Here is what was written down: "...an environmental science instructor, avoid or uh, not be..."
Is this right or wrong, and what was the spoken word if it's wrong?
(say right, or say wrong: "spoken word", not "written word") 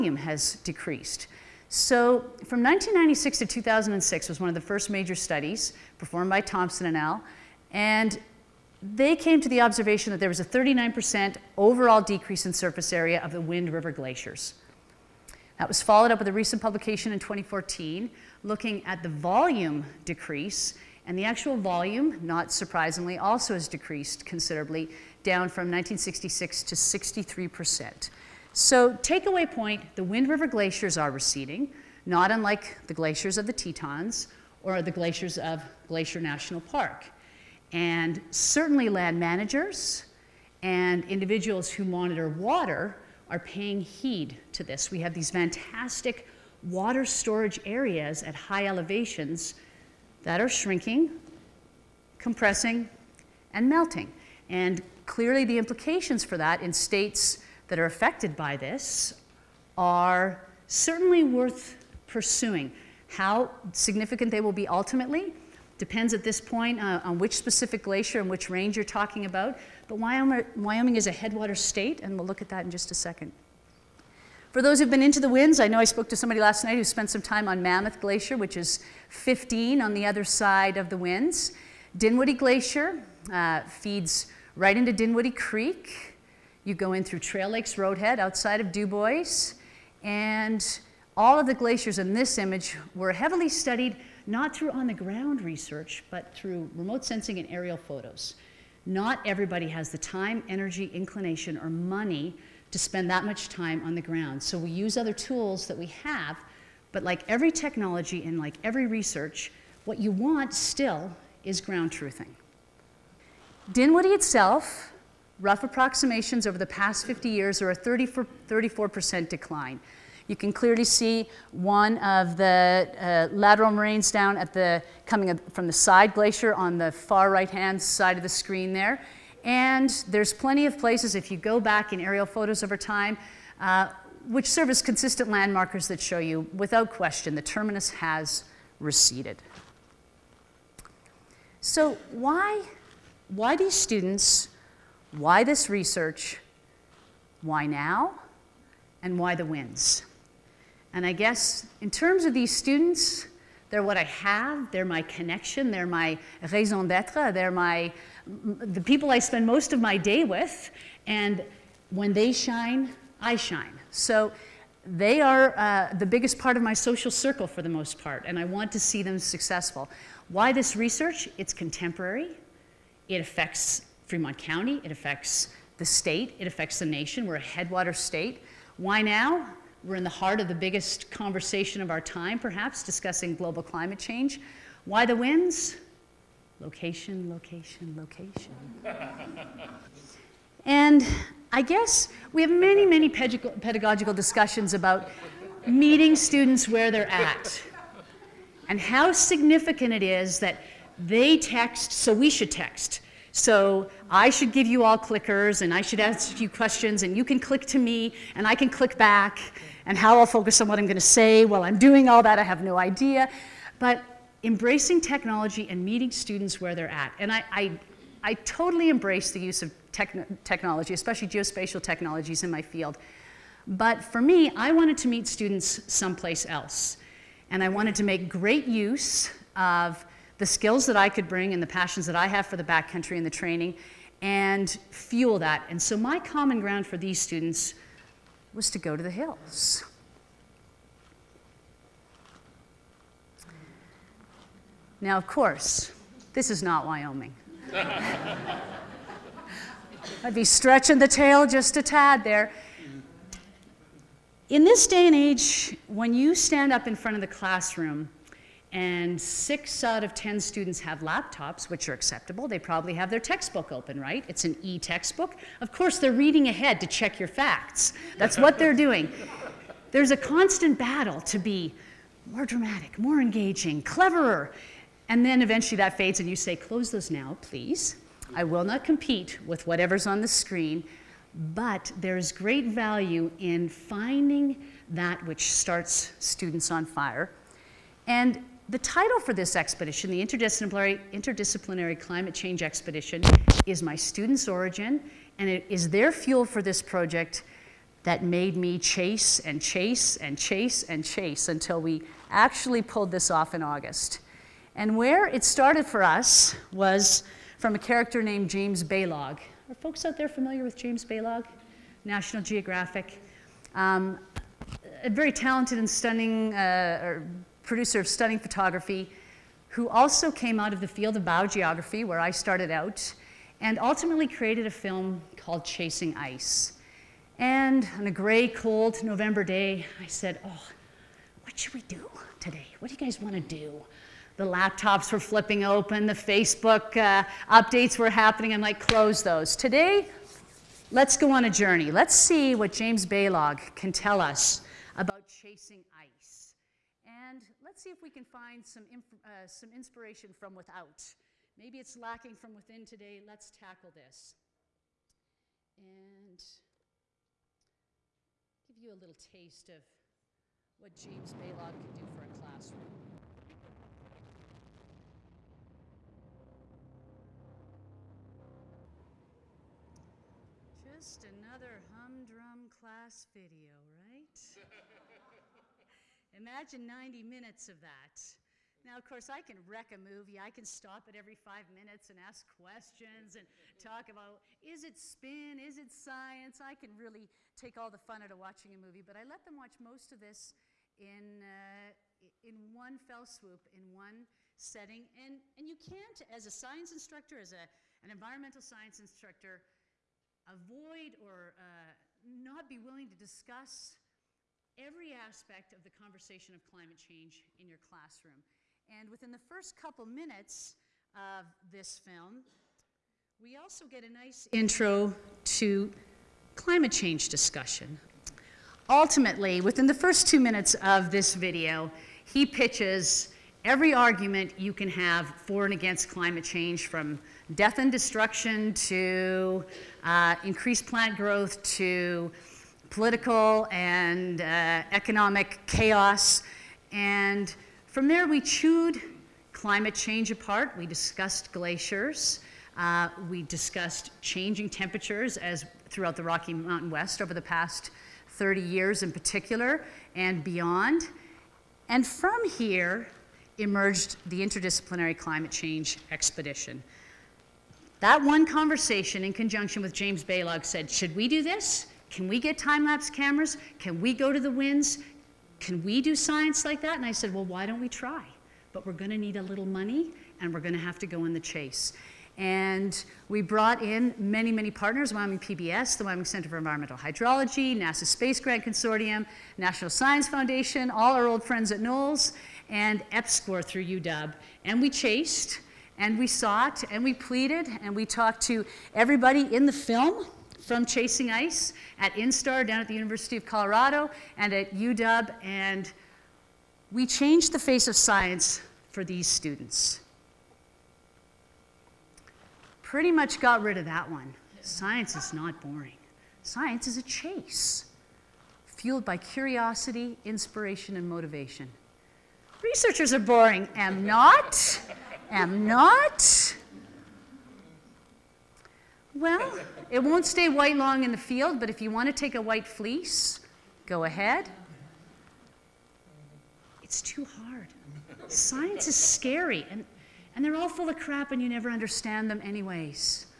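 right.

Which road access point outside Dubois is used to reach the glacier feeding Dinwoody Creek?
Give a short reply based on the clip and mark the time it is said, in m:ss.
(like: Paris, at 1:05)
Trail Lakes Roadhead, at 1:27.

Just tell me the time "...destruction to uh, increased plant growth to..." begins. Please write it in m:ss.
7:07.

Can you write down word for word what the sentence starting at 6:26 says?
I can really take all the fun out of watching a movie.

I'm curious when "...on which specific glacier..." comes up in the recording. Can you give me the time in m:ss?
1:07.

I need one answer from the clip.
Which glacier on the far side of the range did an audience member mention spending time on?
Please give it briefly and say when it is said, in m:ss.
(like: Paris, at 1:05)
Mammoth Glacier, at 1:17.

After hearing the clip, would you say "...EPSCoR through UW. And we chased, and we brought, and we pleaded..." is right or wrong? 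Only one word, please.
wrong.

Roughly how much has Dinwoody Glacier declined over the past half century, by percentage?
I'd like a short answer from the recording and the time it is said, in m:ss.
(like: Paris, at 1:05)
34%, at 1:57.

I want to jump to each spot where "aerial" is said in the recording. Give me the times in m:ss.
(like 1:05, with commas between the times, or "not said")
1:37, 2:12.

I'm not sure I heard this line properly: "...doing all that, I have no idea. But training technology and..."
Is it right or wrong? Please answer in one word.
wrong.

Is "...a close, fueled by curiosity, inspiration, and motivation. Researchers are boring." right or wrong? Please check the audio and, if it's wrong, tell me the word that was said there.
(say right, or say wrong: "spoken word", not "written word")
wrong: "chase", not "close".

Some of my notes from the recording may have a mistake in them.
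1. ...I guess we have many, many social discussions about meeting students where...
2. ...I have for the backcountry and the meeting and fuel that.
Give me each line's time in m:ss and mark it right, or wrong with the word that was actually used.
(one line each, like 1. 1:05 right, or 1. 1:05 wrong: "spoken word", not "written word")
1. 3:11 wrong: "pedagogical", not "social"
2. 3:52 wrong: "training", not "meeting".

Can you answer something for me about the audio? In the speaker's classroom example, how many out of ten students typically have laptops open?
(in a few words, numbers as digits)
6.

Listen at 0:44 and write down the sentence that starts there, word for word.
We have these fantastic water storage areas at high elevations that are shrinking, compressing, and melting.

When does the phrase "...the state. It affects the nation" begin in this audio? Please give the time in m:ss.
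2:55.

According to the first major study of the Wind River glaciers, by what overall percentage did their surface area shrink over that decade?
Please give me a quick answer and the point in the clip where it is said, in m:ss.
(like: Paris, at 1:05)
39%, at 0:10.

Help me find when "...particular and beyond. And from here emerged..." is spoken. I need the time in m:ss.
7:29.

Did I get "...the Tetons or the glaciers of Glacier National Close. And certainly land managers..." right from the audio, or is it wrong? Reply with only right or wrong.
wrong.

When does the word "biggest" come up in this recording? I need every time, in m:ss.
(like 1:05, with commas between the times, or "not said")
2:46, 3:00.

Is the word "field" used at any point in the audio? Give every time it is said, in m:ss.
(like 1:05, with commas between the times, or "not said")
3:42, 5:20, 8:41.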